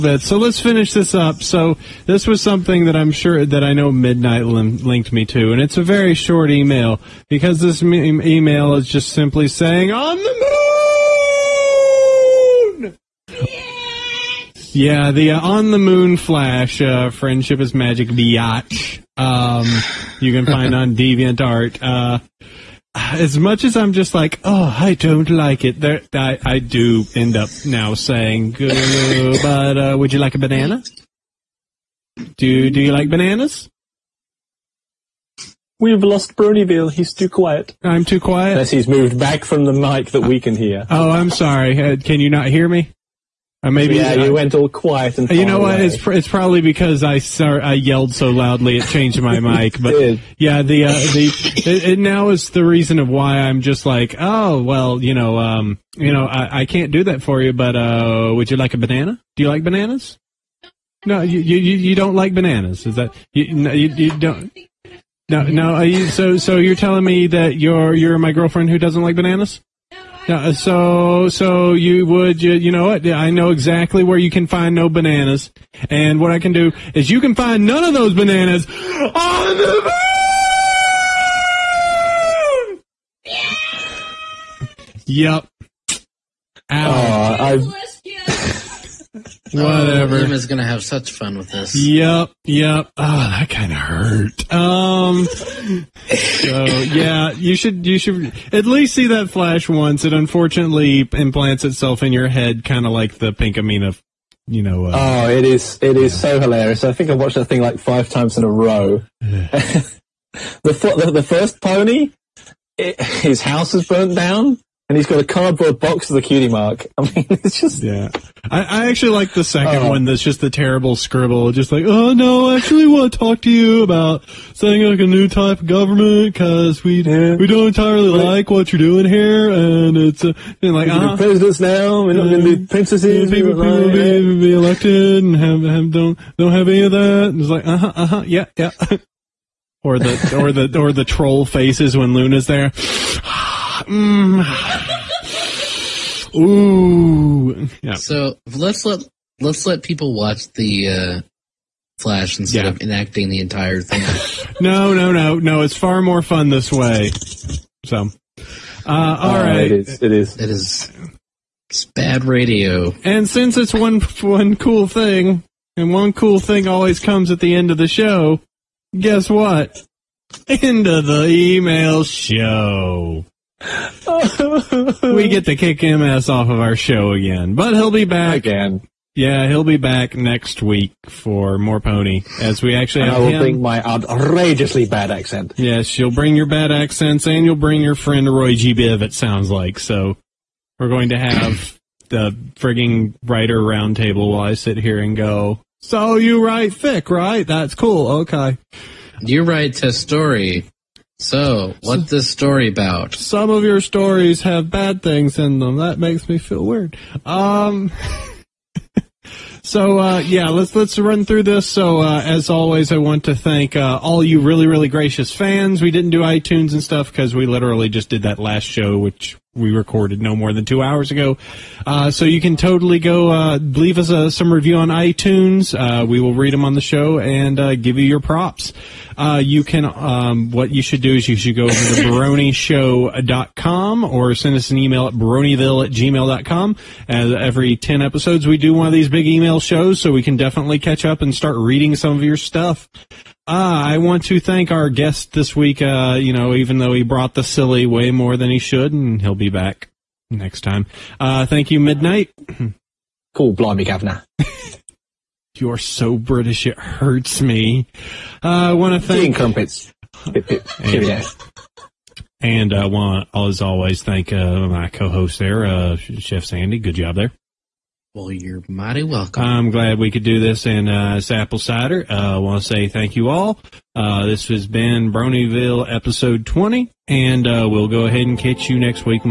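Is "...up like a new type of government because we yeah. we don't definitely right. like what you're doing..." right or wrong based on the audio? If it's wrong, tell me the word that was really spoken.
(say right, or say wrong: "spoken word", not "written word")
wrong: "entirely", not "definitely".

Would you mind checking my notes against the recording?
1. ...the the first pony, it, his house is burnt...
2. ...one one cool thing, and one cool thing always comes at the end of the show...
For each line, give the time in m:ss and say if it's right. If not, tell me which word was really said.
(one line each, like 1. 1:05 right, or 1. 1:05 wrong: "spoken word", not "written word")
1. 1:50 right
2. 2:43 right.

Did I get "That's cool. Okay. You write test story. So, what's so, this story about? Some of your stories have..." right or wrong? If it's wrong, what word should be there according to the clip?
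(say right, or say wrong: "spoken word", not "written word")
right.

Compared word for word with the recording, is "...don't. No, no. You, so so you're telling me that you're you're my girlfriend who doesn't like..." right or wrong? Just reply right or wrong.
right.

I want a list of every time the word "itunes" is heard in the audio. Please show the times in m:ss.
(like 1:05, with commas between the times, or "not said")
3:36, 3:44.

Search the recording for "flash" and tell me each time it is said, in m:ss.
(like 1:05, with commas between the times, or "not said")
0:16, 1:39, 2:31.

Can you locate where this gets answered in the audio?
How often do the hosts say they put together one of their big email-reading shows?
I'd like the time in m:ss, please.
3:57.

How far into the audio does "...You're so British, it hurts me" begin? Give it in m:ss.
4:15.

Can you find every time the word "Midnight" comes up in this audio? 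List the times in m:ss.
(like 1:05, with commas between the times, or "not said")
0:03, 4:11.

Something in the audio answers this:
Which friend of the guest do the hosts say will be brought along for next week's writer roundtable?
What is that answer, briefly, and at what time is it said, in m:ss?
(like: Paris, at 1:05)
Roy G. Biv, at 3:08.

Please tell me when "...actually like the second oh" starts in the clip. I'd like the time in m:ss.
1:58.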